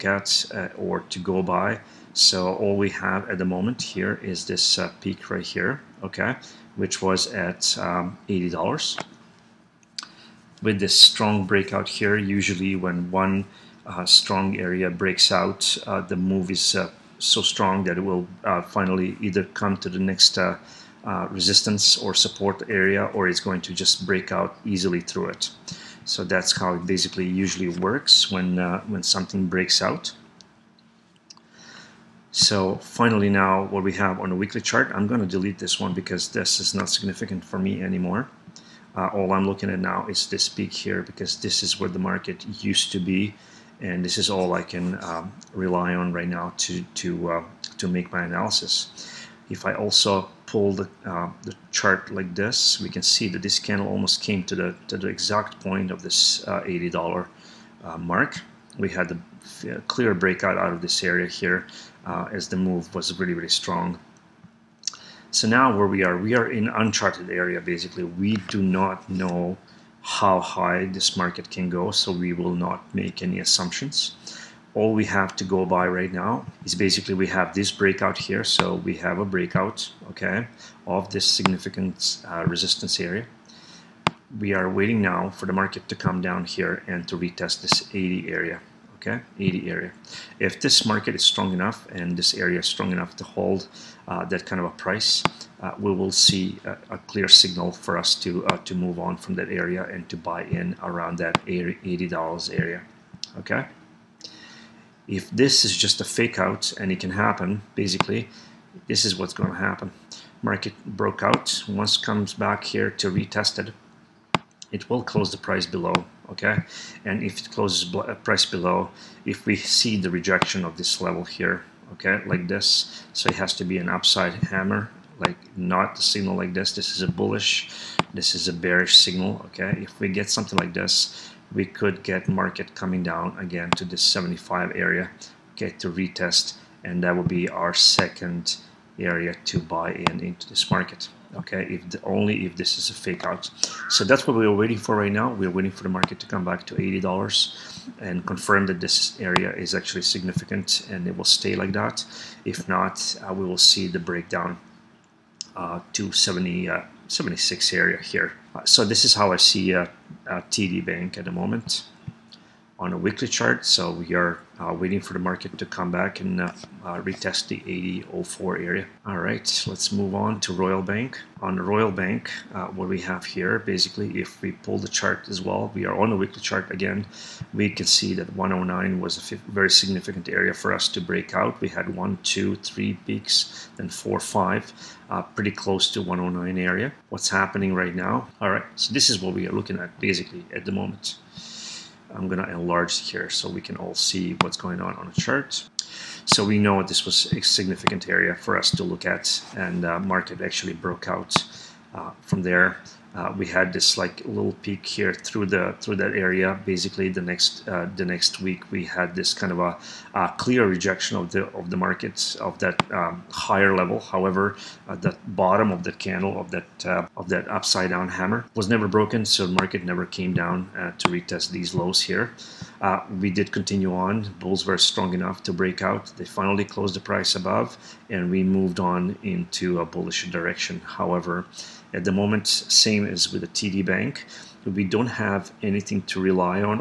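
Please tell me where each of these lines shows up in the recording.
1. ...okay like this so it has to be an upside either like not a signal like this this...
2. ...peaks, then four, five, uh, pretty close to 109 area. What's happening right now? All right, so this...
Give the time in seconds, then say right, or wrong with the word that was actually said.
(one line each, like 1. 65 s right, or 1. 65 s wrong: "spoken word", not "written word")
1. 121 s wrong: "hammer", not "either"
2. 183 s right.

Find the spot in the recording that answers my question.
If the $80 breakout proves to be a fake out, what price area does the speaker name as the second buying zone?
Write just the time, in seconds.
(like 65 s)
134 s.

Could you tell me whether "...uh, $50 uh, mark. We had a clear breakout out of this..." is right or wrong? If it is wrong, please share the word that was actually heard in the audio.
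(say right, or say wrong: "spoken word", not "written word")
wrong: "80", not "50".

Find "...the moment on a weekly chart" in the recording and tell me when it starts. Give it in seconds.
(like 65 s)
161 s.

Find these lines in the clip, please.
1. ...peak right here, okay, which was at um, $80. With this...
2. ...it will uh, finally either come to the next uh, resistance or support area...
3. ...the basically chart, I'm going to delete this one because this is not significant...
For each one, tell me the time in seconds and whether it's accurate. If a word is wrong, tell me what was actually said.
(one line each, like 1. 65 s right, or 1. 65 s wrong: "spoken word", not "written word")
1. 4 s right
2. 17 s right
3. 34 s wrong: "weekly", not "basically".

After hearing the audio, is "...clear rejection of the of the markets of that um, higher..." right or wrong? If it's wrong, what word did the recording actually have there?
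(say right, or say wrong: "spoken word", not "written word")
right.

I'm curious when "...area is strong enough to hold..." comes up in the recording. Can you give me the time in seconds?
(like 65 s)
92 s.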